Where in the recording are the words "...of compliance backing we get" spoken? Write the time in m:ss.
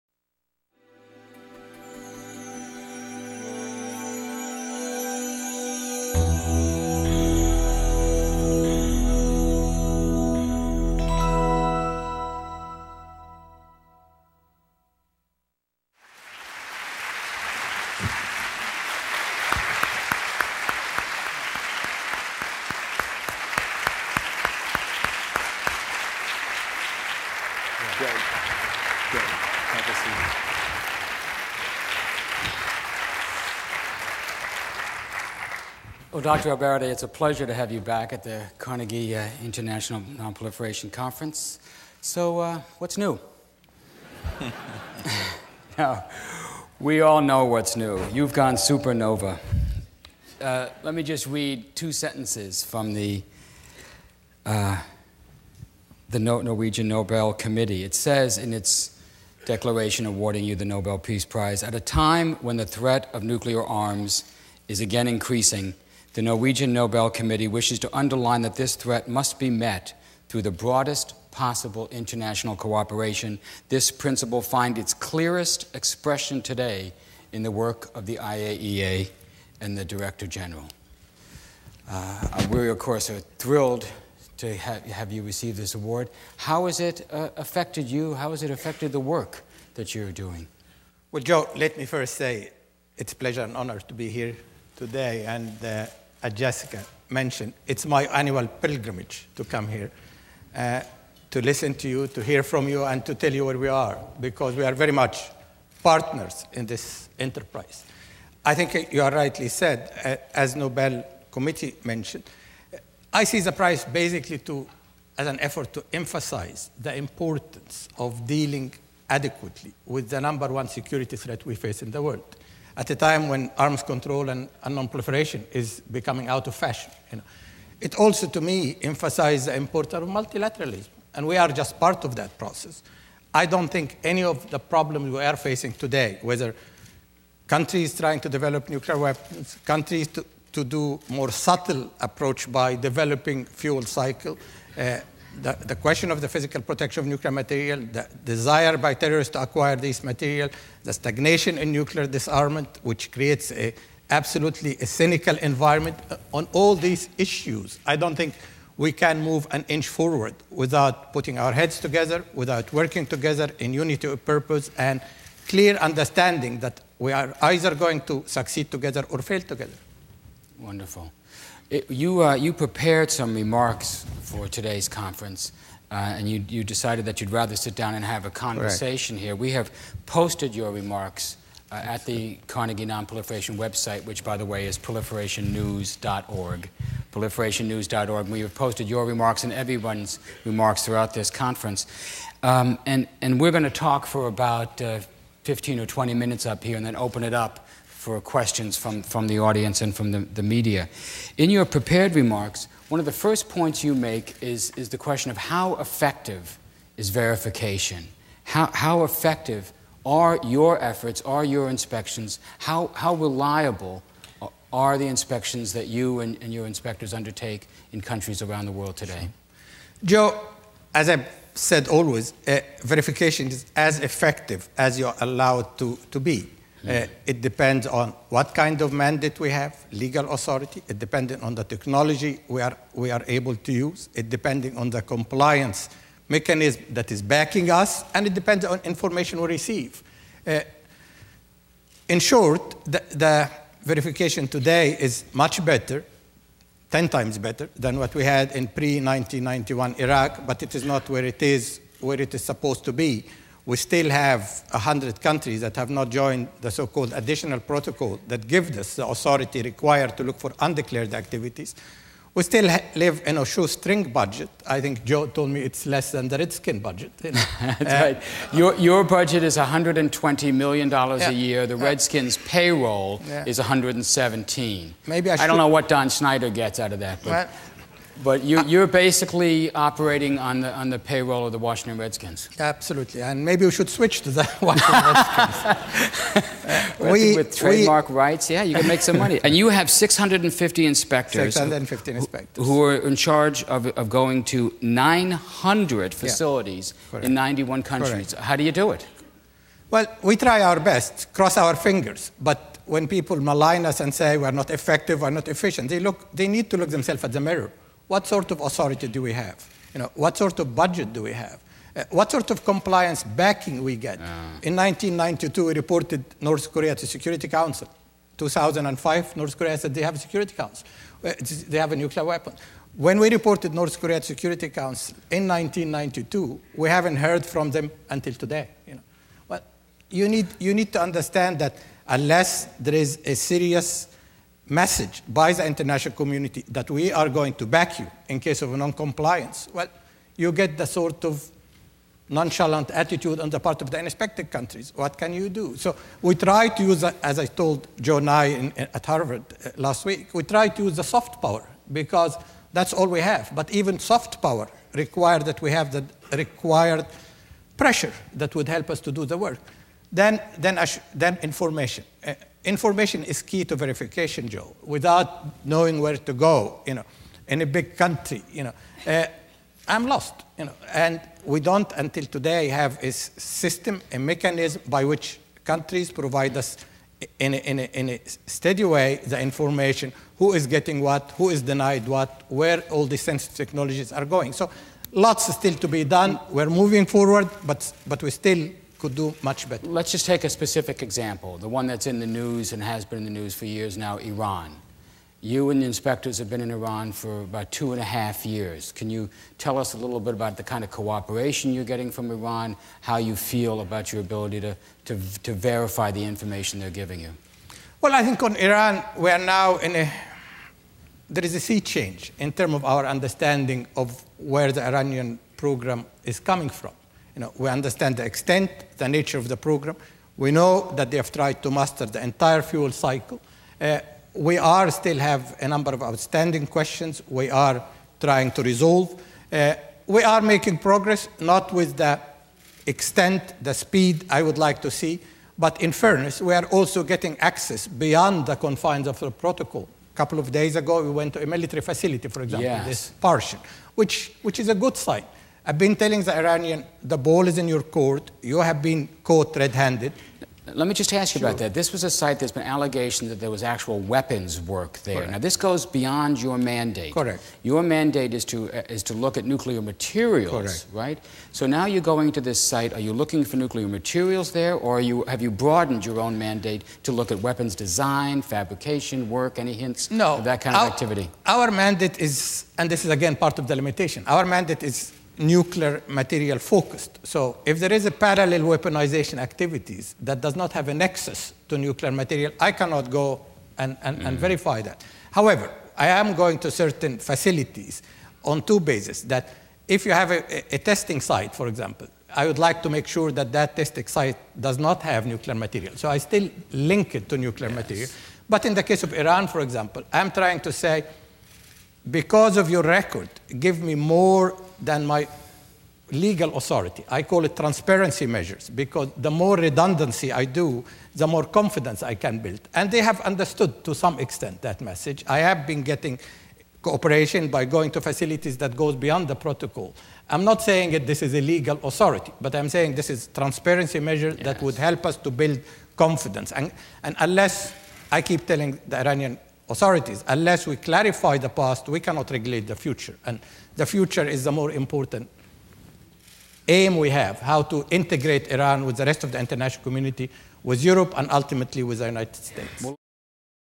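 5:12.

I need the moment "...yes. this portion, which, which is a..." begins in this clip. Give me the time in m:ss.
7:22.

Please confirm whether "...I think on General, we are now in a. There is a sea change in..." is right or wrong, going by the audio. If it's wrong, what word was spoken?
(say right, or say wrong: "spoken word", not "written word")
wrong: "Iran", not "General".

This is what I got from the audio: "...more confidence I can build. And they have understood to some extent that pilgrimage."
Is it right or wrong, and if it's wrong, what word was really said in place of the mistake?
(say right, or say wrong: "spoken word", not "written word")
wrong: "message", not "pilgrimage".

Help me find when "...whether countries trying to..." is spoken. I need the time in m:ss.
2:16.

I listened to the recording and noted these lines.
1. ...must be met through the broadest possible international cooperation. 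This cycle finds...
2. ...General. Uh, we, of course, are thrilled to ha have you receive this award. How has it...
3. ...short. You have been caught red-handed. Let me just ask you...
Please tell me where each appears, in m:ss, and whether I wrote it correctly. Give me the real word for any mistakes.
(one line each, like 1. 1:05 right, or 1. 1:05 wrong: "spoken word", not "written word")
1. 1:09 wrong: "principle", not "cycle"
2. 1:20 right
3. 7:27 wrong: "court", not "short".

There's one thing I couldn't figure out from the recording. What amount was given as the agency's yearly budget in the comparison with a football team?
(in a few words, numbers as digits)
$120 million.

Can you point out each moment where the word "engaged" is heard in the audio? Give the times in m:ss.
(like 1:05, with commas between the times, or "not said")
not said.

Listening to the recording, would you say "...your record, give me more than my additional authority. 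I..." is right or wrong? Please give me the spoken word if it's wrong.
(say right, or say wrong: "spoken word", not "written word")
wrong: "legal", not "additional".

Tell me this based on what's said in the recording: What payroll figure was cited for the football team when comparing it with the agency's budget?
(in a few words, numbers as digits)
117.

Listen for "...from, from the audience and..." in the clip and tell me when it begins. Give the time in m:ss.
3:18.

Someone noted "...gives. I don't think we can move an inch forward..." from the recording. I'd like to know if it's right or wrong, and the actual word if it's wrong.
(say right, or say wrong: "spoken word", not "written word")
wrong: "issues", not "gives".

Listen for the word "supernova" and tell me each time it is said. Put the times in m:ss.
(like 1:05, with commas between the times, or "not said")
0:48.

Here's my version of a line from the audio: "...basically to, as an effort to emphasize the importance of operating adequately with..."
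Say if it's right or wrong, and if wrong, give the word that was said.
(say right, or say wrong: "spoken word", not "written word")
wrong: "dealing", not "operating".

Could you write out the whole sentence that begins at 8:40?
I'm not saying that this is a legal authority, but I'm saying this is transparency measure yes.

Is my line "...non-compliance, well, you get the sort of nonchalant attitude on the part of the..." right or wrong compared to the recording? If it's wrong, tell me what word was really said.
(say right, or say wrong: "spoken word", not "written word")
right.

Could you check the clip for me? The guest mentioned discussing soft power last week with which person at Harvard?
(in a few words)
Joe Nye.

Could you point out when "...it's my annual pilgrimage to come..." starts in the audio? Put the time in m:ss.
1:37.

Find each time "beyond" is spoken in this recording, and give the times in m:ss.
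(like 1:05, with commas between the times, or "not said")
7:17, 7:35, 8:38.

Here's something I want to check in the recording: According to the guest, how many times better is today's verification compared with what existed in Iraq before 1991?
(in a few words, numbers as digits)
10 times.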